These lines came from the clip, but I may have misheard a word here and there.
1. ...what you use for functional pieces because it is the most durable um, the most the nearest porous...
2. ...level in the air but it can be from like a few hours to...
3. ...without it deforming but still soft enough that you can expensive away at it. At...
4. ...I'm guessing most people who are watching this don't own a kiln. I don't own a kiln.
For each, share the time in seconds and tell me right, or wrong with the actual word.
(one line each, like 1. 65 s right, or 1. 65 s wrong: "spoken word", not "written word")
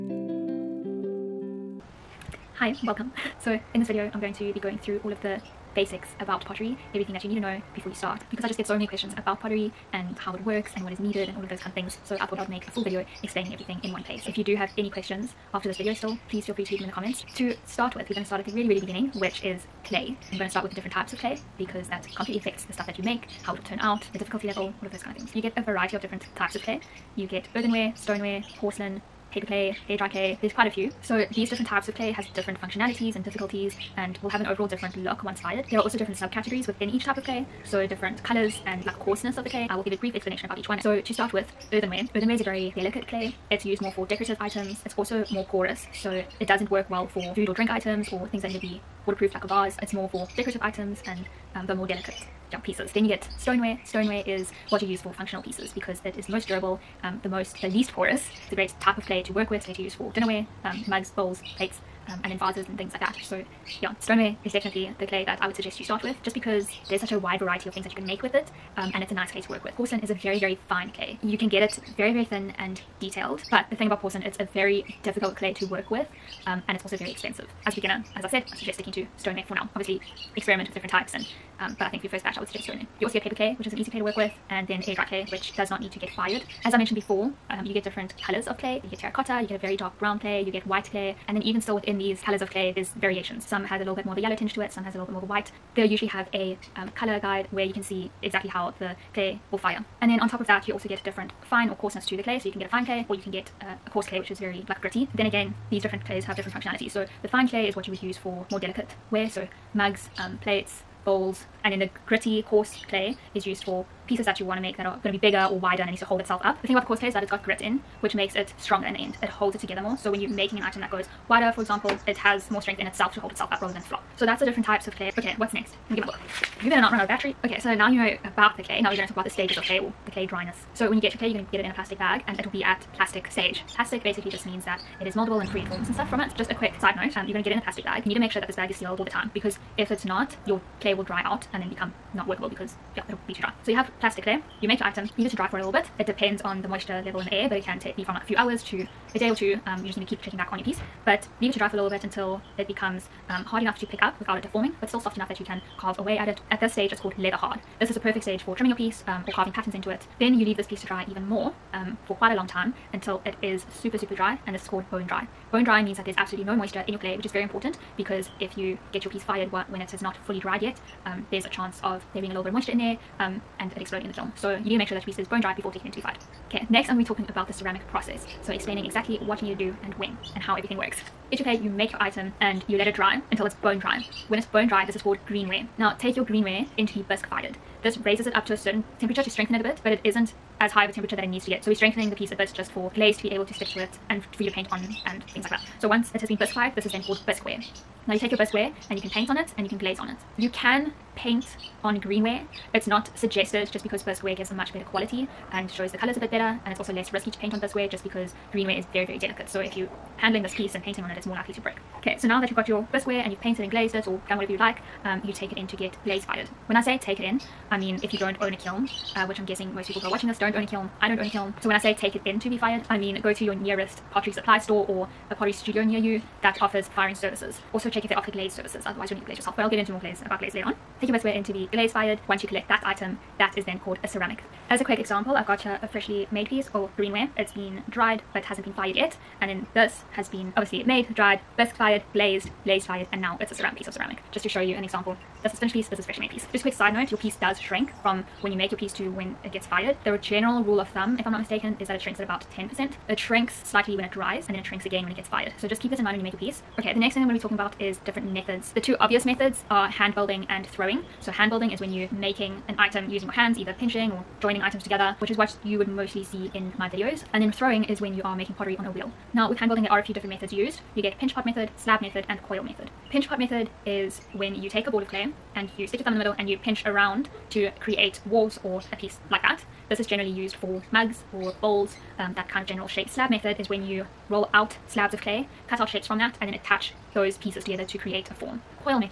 1. 54 s wrong: "least", not "nearest"
2. 147 s right
3. 154 s wrong: "carve", not "expensive"
4. 219 s right.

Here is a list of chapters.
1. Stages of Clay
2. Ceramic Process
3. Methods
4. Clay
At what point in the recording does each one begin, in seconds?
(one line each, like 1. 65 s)
1. 127 s
2. 176 s
3. 256 s
4. 17 s.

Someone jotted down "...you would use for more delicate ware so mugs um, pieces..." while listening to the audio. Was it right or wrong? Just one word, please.
wrong.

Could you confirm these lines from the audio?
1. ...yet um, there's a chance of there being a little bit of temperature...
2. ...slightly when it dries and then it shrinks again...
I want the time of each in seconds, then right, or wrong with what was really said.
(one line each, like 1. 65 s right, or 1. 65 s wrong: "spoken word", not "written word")
1. 170 s wrong: "moisture", not "temperature"
2. 253 s right.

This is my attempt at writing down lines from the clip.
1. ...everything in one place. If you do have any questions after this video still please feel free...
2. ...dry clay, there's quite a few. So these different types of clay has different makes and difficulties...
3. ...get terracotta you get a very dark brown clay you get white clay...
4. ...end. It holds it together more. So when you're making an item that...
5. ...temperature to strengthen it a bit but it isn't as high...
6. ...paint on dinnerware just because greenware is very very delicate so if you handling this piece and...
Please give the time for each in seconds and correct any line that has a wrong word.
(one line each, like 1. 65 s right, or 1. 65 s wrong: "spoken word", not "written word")
1. 13 s right
2. 29 s wrong: "functionalities", not "makes"
3. 88 s right
4. 118 s right
5. 188 s right
6. 207 s wrong: "bisqueware", not "dinnerware".